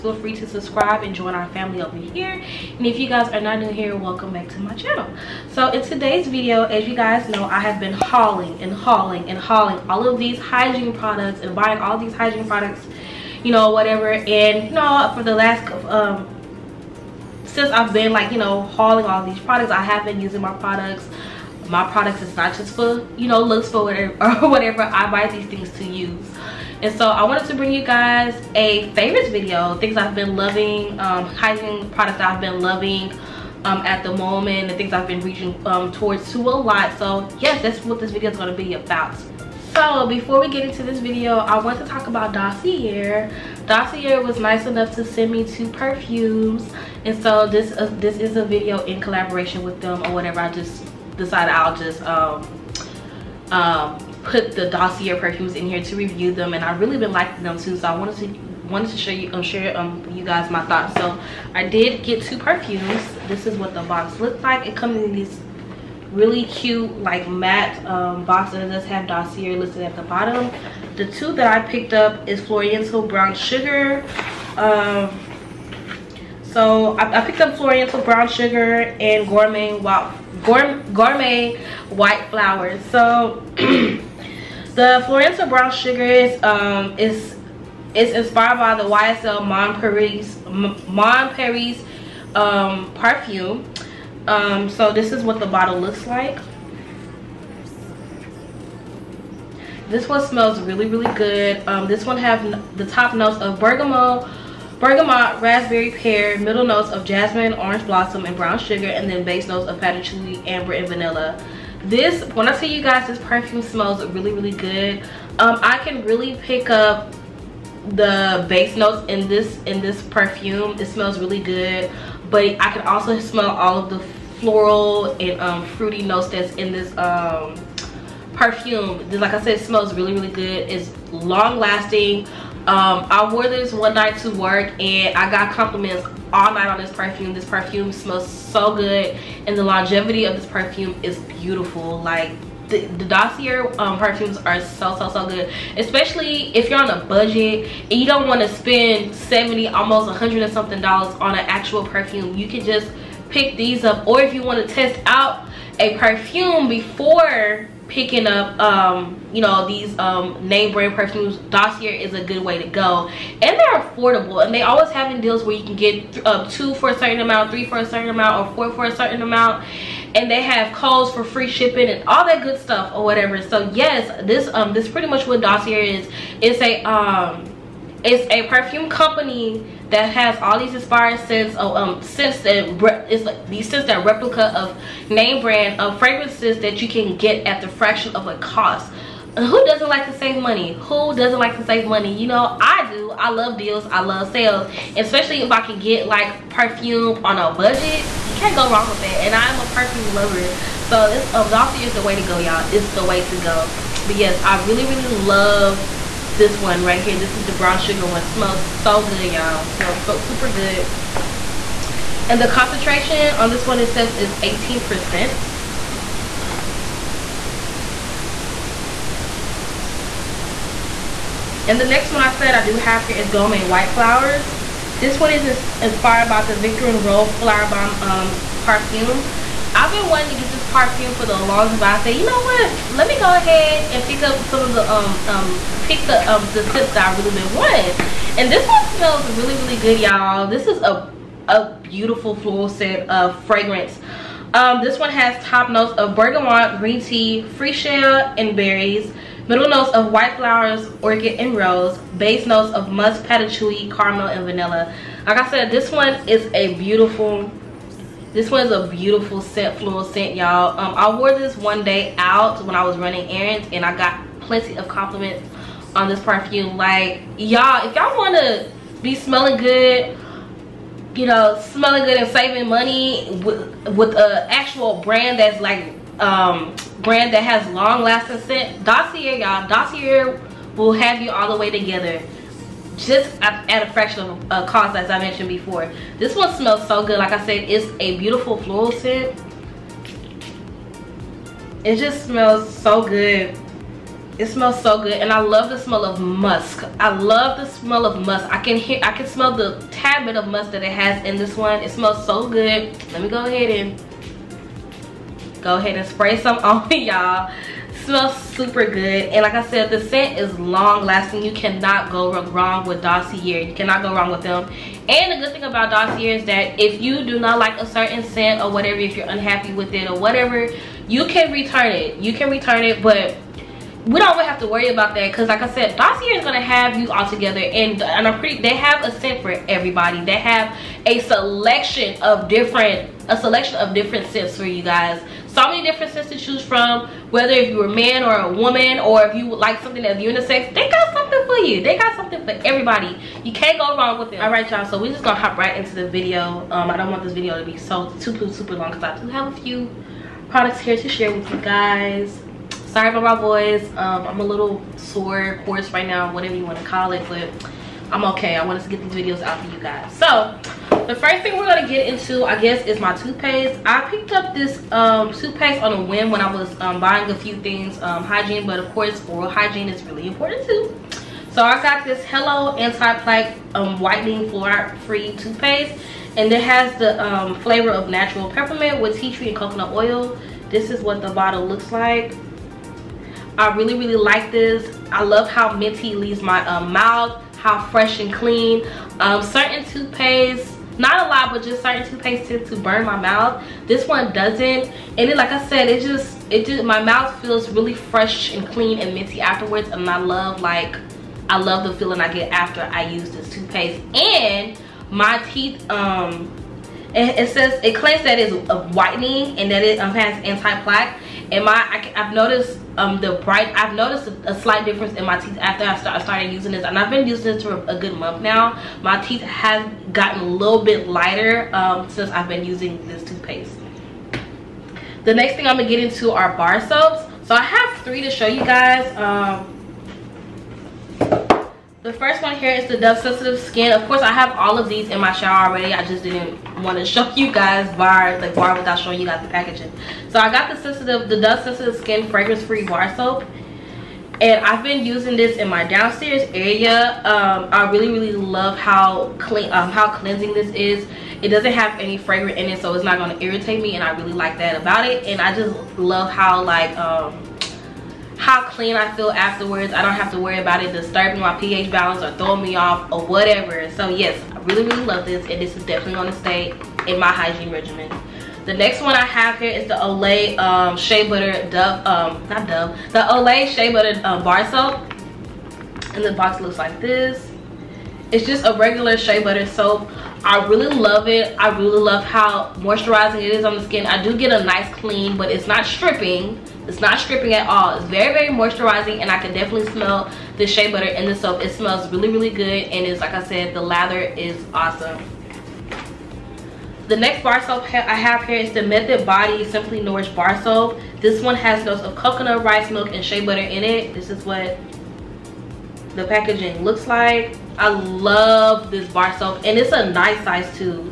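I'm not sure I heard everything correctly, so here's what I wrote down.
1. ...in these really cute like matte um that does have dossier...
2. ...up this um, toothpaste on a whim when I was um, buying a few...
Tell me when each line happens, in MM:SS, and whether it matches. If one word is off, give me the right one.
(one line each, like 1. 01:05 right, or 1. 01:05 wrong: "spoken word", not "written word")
1. 01:04 right
2. 06:04 right.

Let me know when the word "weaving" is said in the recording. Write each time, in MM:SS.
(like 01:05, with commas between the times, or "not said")
not said.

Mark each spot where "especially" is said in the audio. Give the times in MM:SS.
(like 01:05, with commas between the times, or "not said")
02:25, 03:14.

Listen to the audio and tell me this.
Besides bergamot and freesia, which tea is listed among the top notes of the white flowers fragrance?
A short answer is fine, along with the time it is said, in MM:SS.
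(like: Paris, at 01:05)
green tea, at 04:06.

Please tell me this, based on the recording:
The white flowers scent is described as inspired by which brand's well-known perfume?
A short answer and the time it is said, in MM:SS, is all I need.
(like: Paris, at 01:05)
Viktor and Rolf Flowerbomb, at 03:46.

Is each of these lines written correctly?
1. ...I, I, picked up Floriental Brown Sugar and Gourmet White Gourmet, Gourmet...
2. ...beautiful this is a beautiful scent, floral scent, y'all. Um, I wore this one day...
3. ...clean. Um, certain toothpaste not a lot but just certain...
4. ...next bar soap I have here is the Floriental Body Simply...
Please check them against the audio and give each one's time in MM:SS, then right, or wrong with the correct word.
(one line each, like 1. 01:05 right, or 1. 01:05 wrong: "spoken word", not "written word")
1. 01:16 right
2. 04:16 right
3. 06:28 right
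4. 08:17 wrong: "Method", not "Floriental".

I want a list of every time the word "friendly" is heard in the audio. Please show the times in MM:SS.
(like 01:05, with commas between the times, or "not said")
not said.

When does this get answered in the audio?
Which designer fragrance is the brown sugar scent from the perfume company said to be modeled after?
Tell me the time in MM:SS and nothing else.
01:28.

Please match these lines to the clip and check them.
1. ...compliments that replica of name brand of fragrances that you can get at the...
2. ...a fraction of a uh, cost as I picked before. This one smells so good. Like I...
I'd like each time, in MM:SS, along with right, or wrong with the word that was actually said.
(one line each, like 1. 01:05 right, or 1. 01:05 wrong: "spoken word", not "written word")
1. 03:03 wrong: "scents", not "compliments"
2. 04:43 wrong: "mentioned", not "picked".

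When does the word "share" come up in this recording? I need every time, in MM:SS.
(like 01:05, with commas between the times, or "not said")
00:59, 05:51.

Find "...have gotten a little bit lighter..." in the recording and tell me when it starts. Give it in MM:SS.
06:59.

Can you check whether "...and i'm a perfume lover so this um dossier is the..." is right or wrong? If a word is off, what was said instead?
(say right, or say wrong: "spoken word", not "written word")
right.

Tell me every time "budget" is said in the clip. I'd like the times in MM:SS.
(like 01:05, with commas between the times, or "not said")
02:27, 03:17.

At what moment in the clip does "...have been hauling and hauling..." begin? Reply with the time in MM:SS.
00:07.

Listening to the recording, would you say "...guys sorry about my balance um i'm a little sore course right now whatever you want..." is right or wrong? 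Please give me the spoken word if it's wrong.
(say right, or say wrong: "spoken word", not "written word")
wrong: "voice", not "balance".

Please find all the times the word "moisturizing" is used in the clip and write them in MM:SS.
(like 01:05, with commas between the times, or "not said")
08:02, 08:08.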